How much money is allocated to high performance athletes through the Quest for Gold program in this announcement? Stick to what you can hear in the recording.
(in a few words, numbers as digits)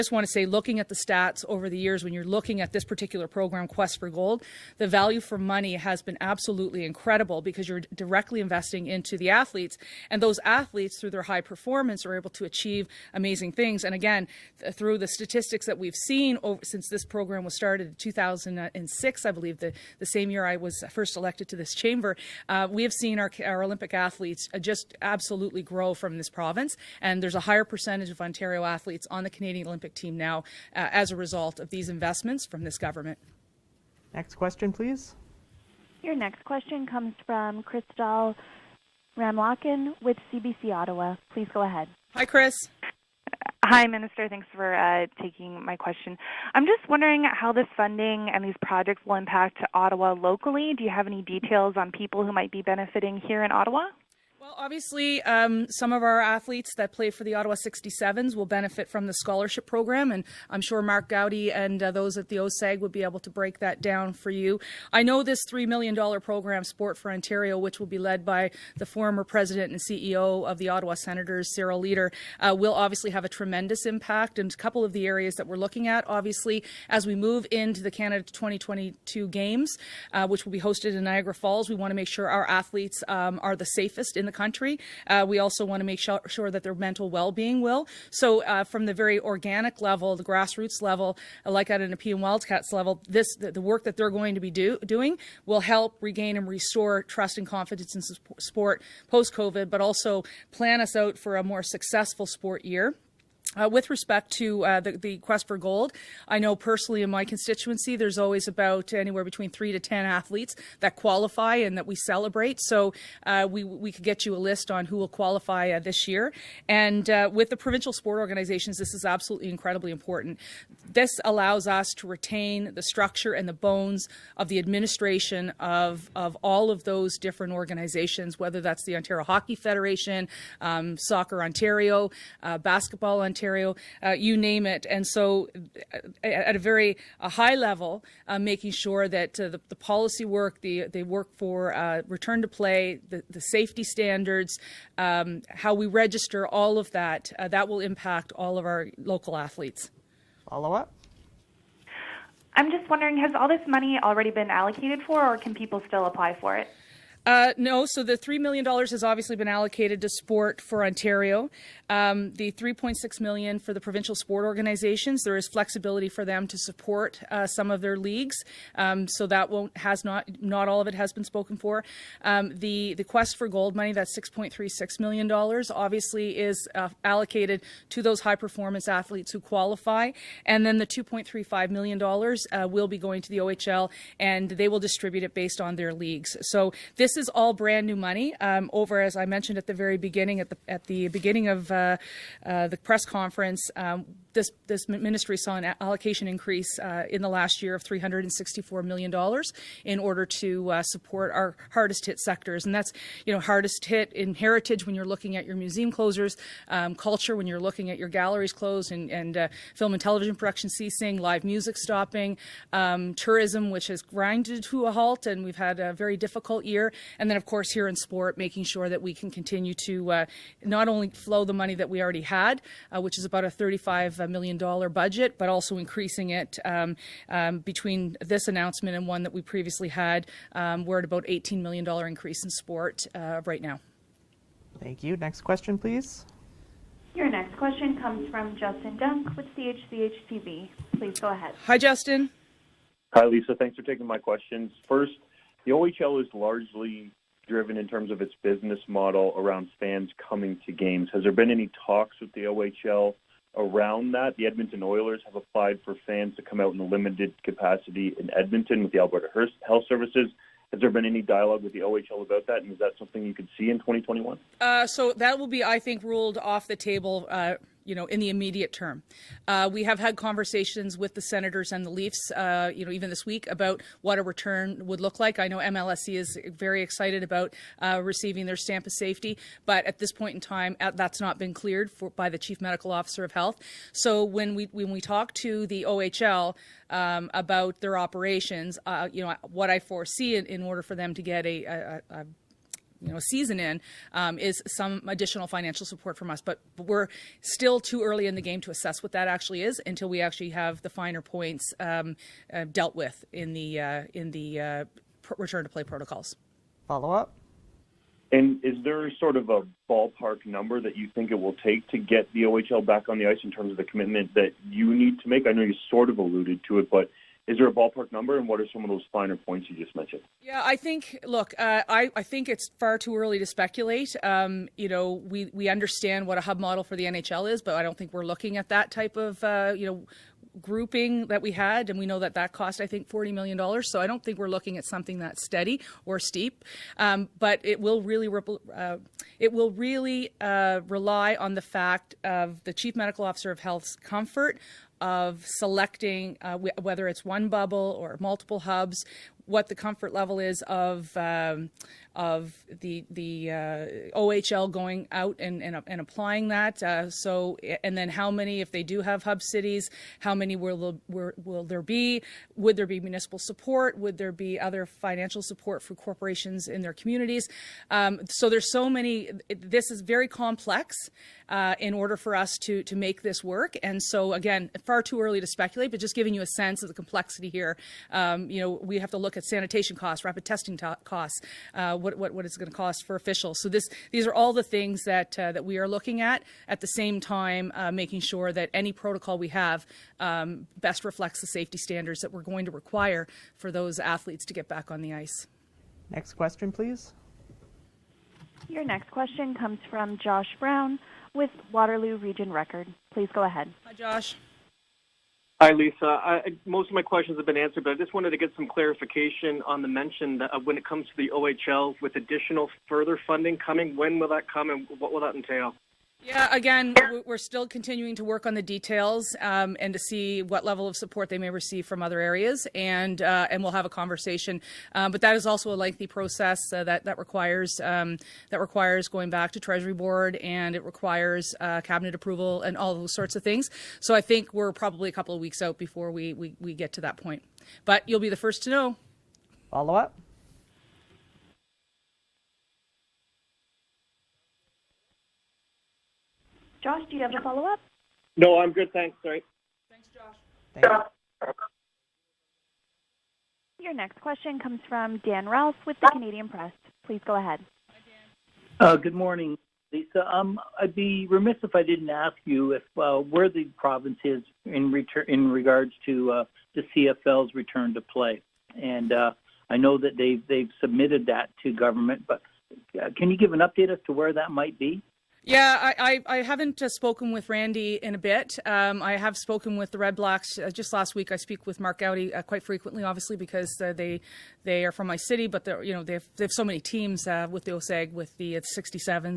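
$6.36 million.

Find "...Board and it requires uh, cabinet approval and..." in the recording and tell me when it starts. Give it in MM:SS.
07:09.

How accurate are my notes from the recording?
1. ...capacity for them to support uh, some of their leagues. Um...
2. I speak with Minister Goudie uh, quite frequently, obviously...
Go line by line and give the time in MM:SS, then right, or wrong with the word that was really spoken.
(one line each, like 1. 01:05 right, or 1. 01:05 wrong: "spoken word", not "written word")
1. 02:45 wrong: "flexibility", not "capacity"
2. 08:01 wrong: "Mark", not "Minister".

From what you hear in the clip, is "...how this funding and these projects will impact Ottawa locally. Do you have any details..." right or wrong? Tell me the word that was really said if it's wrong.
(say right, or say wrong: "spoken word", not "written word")
right.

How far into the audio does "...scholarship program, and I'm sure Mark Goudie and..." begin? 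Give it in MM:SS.
00:59.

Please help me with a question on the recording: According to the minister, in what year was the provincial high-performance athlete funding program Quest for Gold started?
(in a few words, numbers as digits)
2006.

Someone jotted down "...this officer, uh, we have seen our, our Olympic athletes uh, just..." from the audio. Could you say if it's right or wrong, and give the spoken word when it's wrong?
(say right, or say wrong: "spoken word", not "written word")
wrong: "chamber", not "officer".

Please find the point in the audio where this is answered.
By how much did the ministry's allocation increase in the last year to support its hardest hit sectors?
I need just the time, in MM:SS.
03:17.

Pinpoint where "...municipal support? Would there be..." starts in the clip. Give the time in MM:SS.
06:02.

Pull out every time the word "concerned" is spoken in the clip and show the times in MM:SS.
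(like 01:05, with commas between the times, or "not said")
not said.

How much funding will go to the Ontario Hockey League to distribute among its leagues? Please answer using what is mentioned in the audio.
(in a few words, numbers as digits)
$2.35 million.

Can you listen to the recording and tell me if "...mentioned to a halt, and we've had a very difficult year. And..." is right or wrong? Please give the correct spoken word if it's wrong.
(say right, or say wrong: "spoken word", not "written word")
wrong: "grinded", not "mentioned".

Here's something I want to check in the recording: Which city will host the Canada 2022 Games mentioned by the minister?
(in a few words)
Niagara Falls.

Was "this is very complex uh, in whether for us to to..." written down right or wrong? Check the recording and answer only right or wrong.
wrong.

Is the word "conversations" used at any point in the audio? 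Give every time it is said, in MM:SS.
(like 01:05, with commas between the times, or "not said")
04:30, 07:03.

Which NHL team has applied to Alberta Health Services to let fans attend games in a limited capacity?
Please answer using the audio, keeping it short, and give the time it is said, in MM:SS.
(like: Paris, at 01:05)
Edmonton Oilers, at 04:14.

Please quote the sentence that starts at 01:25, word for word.
Uh, we also want to make sure, sure that their mental well-being will.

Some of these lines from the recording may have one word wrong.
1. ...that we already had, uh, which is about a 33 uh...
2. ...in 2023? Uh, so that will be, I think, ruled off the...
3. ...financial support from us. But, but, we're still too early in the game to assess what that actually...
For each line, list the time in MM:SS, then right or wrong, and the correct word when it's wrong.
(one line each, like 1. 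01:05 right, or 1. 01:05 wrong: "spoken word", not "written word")
1. 03:41 wrong: "35", not "33"
2. 04:23 wrong: "2021", not "2023"
3. 04:55 right.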